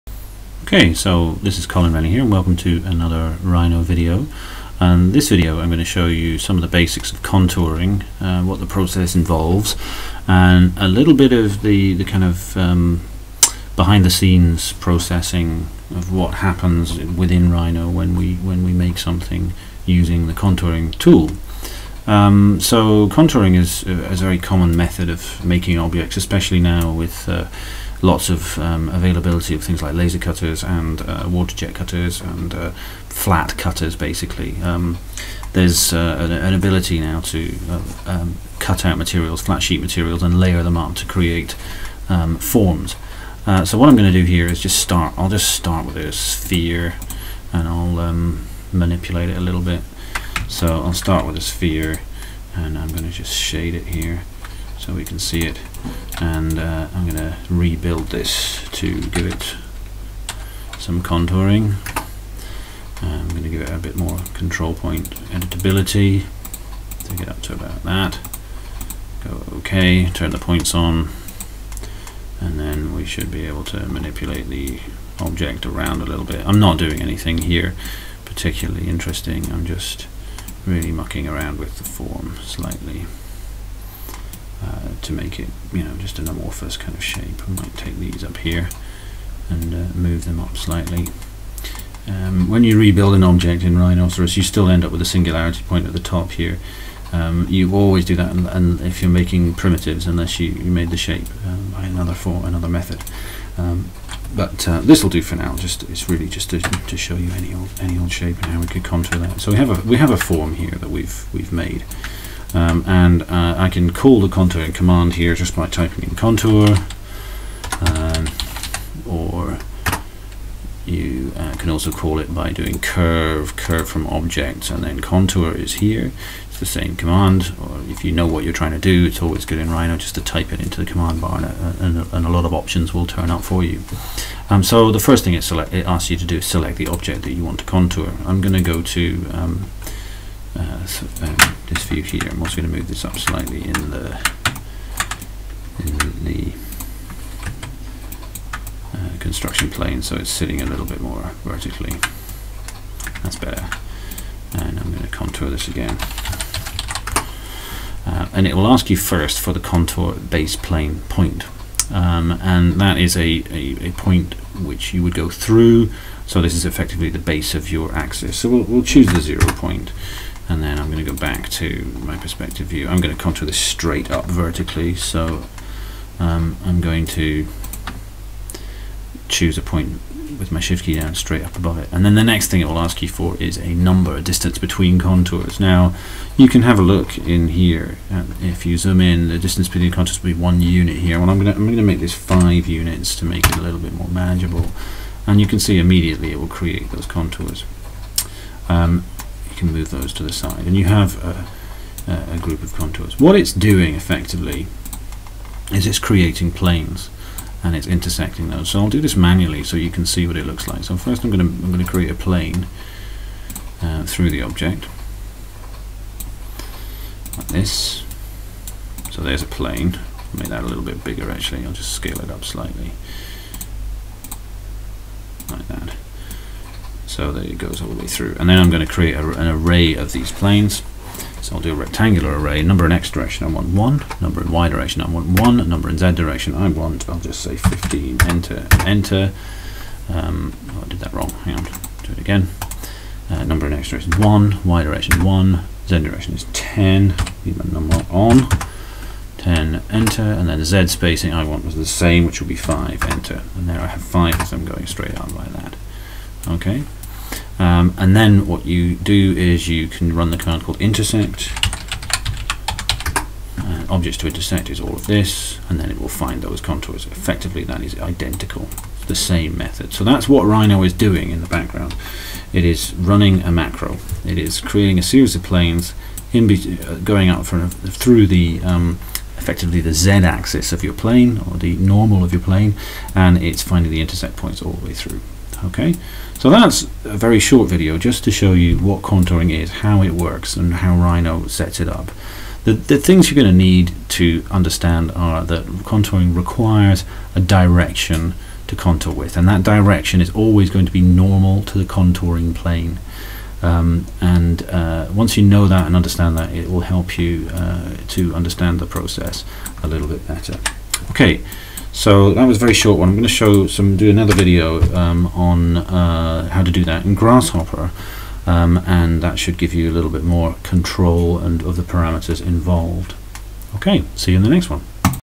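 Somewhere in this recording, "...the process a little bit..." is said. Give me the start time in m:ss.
5:08.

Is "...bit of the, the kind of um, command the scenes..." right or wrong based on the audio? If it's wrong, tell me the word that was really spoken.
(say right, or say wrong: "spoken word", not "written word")
wrong: "behind", not "command".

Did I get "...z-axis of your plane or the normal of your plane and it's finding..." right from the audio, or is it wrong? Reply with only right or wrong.
right.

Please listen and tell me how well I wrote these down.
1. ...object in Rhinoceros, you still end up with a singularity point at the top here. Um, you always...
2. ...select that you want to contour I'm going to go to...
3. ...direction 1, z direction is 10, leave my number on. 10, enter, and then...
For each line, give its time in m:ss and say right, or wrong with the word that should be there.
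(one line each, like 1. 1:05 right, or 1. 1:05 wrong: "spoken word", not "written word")
1. 1:33 right
2. 2:16 wrong: "object", not "select"
3. 4:04 right.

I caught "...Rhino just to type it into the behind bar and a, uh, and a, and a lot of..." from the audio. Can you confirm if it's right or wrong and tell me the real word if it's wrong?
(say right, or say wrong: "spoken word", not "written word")
wrong: "command", not "behind".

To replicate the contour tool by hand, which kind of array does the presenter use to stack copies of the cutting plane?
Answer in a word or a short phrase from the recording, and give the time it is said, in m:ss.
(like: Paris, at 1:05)
rectangular array, at 3:51.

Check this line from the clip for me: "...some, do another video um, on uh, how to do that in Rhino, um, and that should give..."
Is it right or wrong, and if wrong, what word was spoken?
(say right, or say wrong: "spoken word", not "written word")
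wrong: "Grasshopper", not "Rhino".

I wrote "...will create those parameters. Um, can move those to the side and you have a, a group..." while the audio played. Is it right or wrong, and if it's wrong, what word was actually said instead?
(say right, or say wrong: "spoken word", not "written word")
wrong: "contours", not "parameters".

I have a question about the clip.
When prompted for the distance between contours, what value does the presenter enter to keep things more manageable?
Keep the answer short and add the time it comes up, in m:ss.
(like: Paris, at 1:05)
5, at 3:11.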